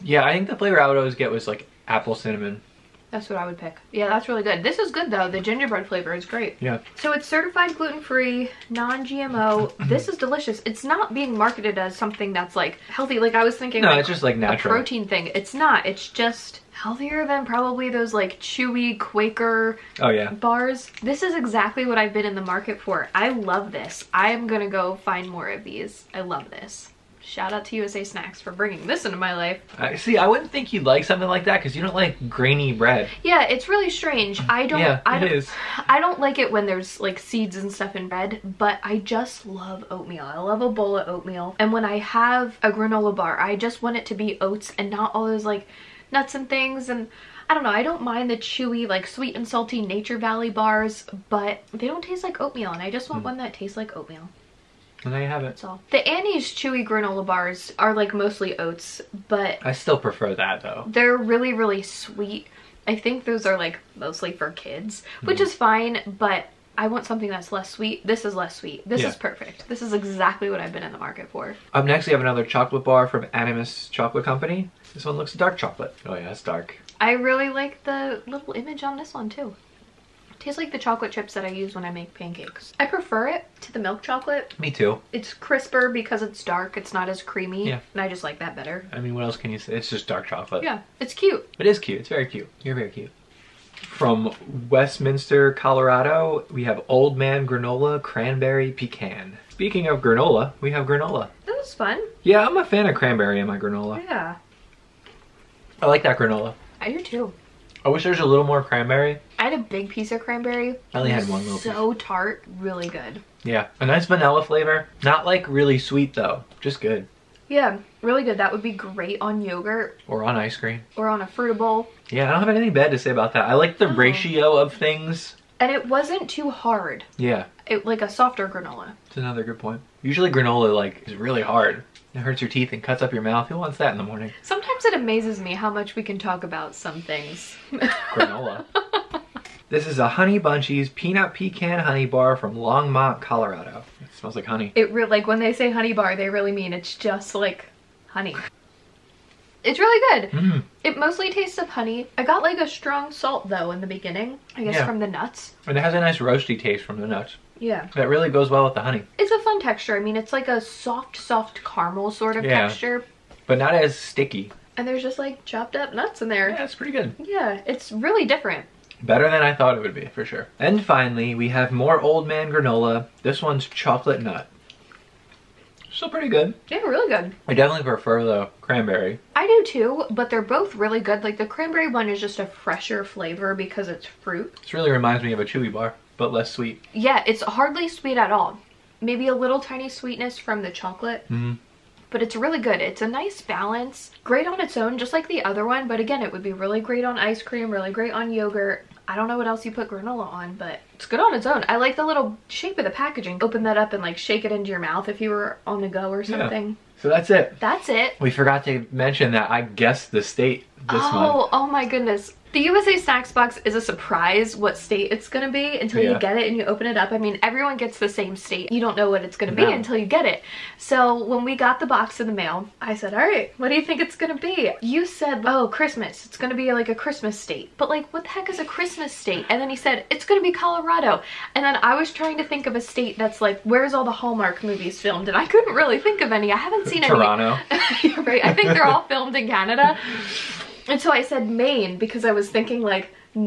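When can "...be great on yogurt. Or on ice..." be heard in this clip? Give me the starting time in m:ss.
1:58.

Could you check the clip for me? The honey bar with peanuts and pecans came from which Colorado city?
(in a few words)
Longmont.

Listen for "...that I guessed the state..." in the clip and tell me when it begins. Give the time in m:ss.
3:29.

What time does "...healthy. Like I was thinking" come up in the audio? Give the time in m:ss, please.
0:12.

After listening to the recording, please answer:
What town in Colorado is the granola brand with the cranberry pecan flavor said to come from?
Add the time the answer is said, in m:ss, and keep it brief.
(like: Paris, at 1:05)
Westminster, at 1:34.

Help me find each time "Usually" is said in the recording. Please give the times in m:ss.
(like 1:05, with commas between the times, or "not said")
2:10.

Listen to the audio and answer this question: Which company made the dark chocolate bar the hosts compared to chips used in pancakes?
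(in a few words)
Animas Chocolate Company.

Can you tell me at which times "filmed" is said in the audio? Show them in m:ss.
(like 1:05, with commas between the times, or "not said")
3:55, 3:59.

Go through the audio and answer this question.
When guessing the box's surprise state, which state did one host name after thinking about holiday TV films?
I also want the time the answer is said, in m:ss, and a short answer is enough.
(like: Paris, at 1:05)
Maine, at 4:01.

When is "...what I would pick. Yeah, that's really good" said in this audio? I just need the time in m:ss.
0:03.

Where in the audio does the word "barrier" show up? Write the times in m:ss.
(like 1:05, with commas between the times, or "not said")
not said.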